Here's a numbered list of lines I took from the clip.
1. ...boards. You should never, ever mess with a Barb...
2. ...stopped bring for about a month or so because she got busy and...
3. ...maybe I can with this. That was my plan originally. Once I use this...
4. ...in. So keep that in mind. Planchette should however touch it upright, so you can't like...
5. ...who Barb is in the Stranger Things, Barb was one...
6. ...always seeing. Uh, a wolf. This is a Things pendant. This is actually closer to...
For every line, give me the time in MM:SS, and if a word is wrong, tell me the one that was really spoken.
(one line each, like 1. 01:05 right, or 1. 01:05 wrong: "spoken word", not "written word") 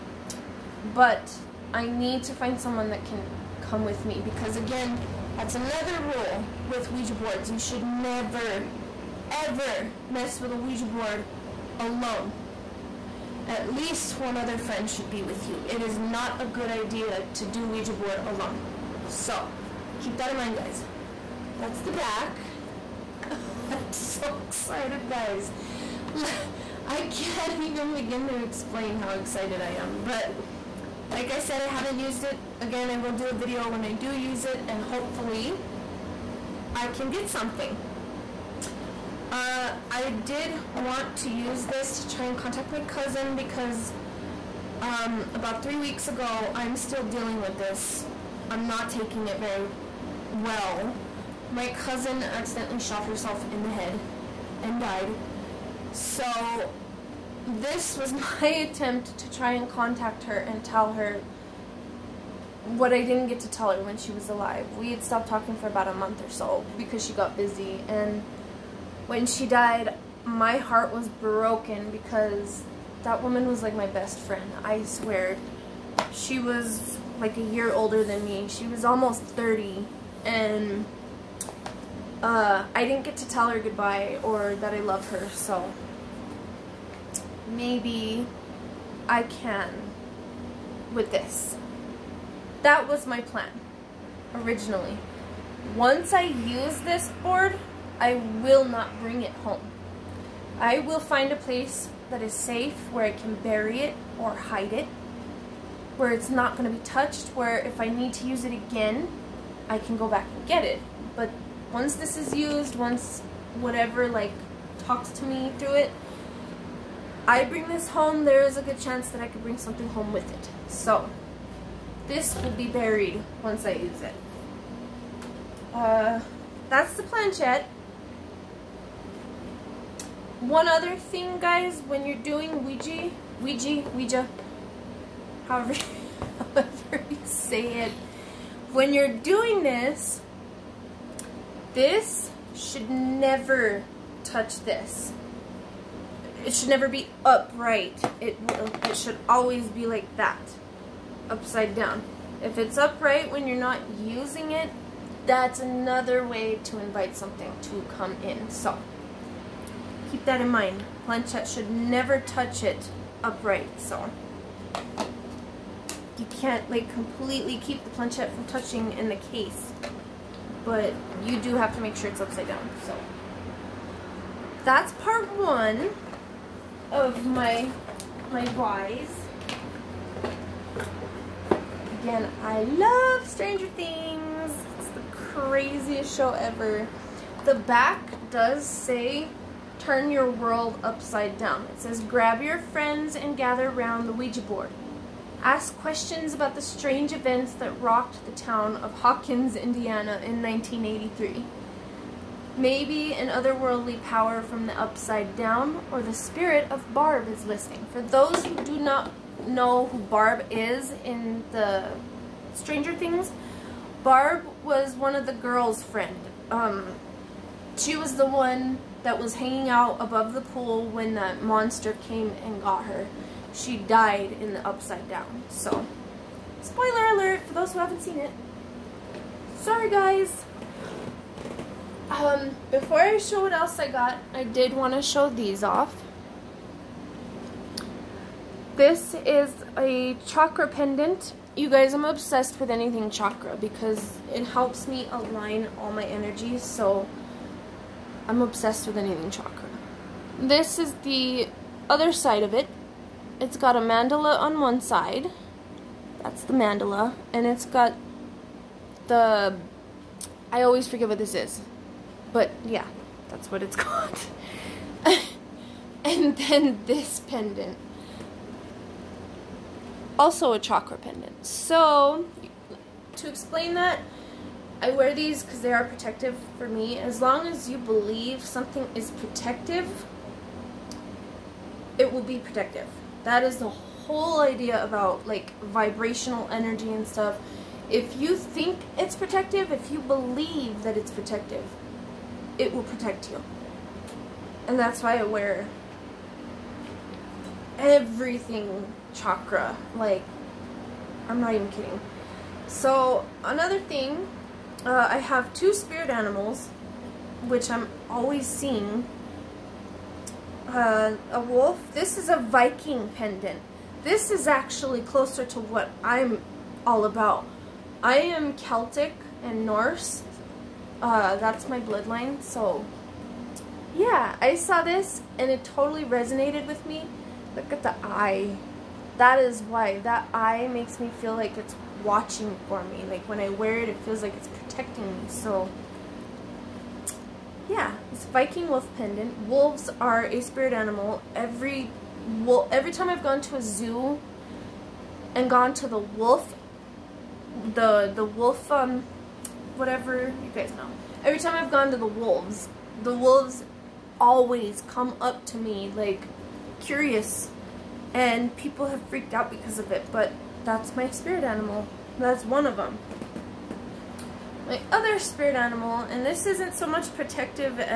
1. 00:07 wrong: "Ouija", not "Barb"
2. 01:05 wrong: "talking", not "bring"
3. 01:27 right
4. 02:38 wrong: "never", not "however"
5. 03:29 right
6. 05:08 wrong: "Viking", not "Things".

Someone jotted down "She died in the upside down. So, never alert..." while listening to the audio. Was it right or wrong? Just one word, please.
wrong.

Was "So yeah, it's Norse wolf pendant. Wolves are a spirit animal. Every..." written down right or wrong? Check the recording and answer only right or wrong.
wrong.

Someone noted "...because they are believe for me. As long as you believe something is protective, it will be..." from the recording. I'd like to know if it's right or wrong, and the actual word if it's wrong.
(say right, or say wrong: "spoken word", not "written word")
wrong: "protective", not "believe".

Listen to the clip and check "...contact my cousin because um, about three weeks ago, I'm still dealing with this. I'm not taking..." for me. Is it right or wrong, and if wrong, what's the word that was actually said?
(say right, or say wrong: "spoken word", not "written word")
right.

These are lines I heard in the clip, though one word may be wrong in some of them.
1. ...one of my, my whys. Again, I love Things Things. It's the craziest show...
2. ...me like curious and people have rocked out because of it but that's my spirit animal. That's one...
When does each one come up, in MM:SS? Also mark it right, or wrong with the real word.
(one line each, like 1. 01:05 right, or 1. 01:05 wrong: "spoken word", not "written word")
1. 02:55 wrong: "Stranger", not "Things"
2. 05:55 wrong: "freaked", not "rocked".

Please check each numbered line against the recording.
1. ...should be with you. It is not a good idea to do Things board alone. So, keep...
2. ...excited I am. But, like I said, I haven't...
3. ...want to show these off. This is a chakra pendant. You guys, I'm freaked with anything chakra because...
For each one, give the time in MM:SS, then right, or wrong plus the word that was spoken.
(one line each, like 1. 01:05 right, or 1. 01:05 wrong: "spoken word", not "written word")
1. 00:14 wrong: "Ouija", not "Things"
2. 00:29 right
3. 03:54 wrong: "obsessed", not "freaked".